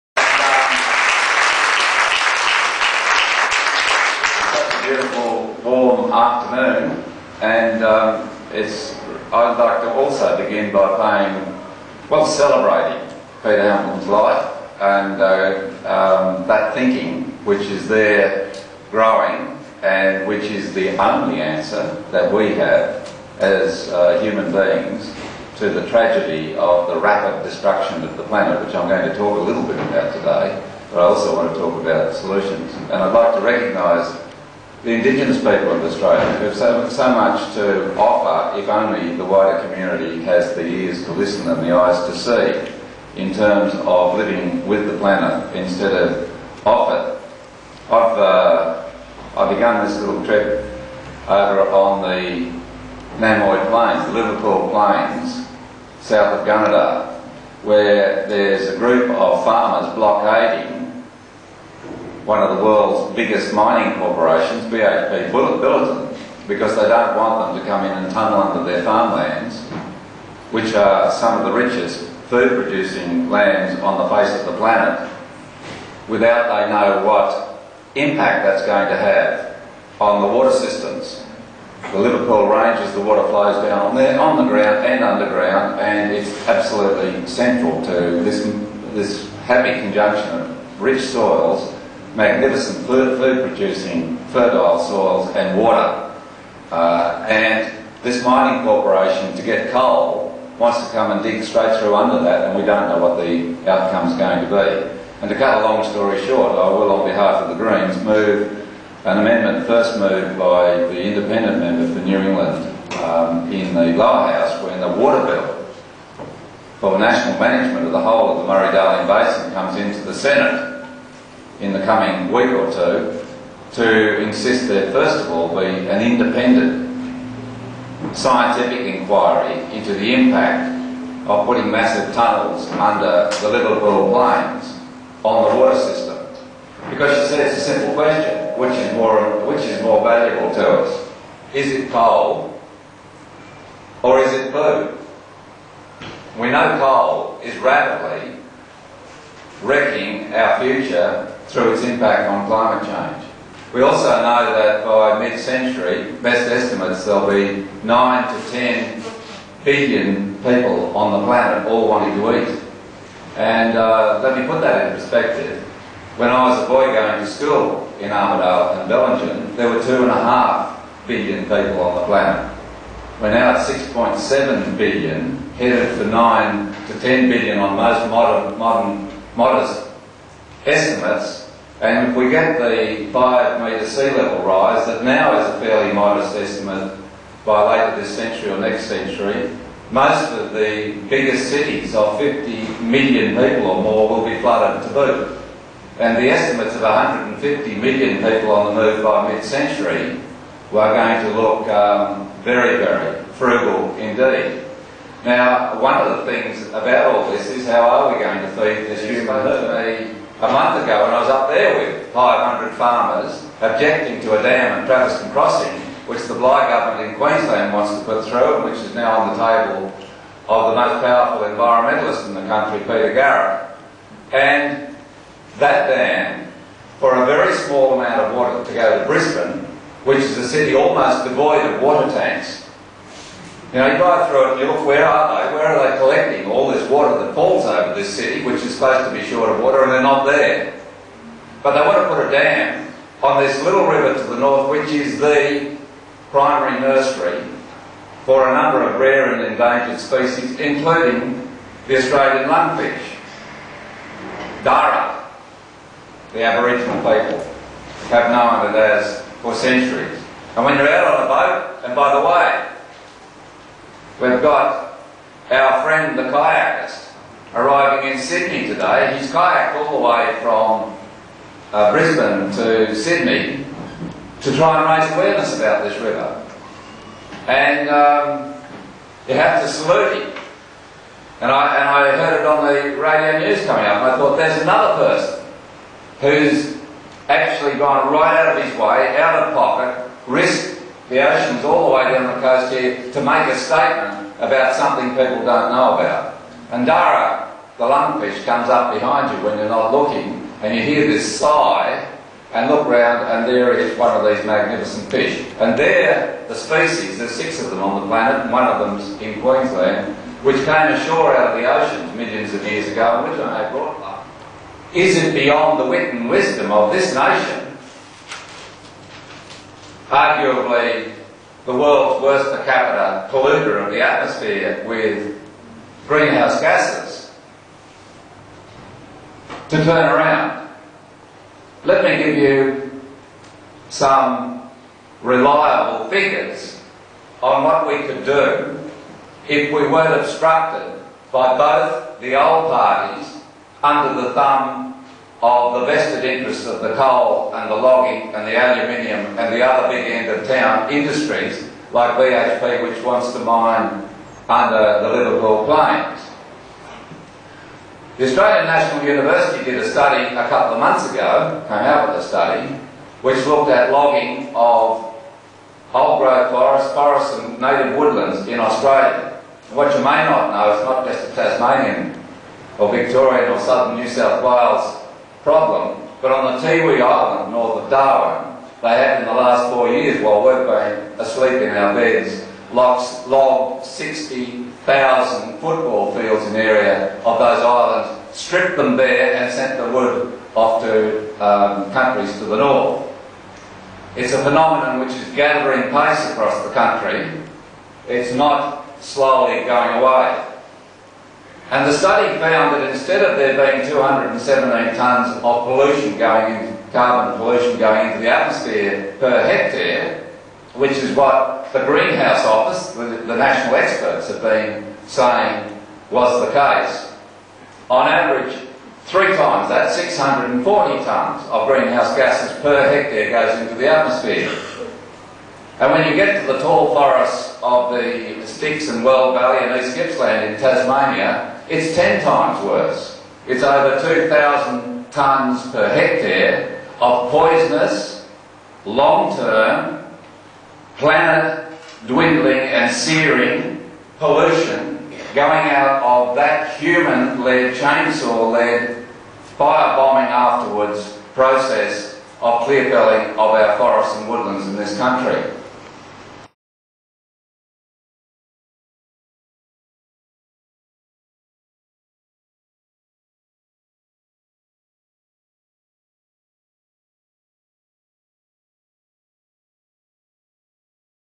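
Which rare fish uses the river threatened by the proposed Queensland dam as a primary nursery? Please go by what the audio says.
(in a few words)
Australian lungfish.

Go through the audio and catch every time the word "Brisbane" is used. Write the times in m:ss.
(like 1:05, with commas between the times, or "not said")
3:49, 4:31.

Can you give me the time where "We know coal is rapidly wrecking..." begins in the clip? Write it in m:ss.
2:26.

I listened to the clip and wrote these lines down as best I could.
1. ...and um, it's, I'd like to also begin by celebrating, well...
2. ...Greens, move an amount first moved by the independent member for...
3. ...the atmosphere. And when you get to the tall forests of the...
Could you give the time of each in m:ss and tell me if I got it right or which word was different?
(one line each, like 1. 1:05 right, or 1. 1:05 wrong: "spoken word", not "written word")
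1. 0:07 wrong: "paying", not "celebrating"
2. 1:47 wrong: "amendment", not "amount"
3. 7:03 right.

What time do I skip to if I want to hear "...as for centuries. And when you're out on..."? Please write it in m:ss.
4:18.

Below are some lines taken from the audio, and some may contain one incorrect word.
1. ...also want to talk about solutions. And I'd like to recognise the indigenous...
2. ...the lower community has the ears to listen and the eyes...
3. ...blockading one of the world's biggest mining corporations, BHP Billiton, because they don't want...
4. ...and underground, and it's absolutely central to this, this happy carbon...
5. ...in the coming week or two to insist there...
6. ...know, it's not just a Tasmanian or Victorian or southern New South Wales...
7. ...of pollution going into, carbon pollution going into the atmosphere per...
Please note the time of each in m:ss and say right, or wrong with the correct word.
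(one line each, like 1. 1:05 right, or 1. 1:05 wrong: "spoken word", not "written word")
1. 0:31 right
2. 0:39 wrong: "wider", not "lower"
3. 0:59 right
4. 1:24 wrong: "conjunction", not "carbon"
5. 2:01 right
6. 6:10 right
7. 6:45 right.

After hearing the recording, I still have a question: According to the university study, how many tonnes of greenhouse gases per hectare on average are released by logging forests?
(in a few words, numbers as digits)
640 tonnes.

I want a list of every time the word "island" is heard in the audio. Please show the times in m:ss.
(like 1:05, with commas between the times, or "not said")
6:17, 6:27.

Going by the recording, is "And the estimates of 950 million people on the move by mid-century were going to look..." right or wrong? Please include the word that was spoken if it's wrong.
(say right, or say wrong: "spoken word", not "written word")
wrong: "150", not "950".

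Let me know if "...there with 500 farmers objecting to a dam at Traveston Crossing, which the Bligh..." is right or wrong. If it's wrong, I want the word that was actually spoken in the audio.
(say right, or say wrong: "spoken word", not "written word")
right.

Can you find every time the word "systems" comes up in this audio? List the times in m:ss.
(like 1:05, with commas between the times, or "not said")
1:20, 2:15.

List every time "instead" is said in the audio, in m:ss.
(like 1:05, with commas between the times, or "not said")
0:45, 6:42.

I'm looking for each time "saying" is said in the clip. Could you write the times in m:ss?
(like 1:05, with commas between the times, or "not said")
6:55.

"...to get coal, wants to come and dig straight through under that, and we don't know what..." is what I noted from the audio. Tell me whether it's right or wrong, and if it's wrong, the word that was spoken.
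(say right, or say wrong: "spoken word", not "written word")
right.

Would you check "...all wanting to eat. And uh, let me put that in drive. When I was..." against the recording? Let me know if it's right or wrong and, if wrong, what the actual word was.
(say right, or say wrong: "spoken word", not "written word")
wrong: "perspective", not "drive".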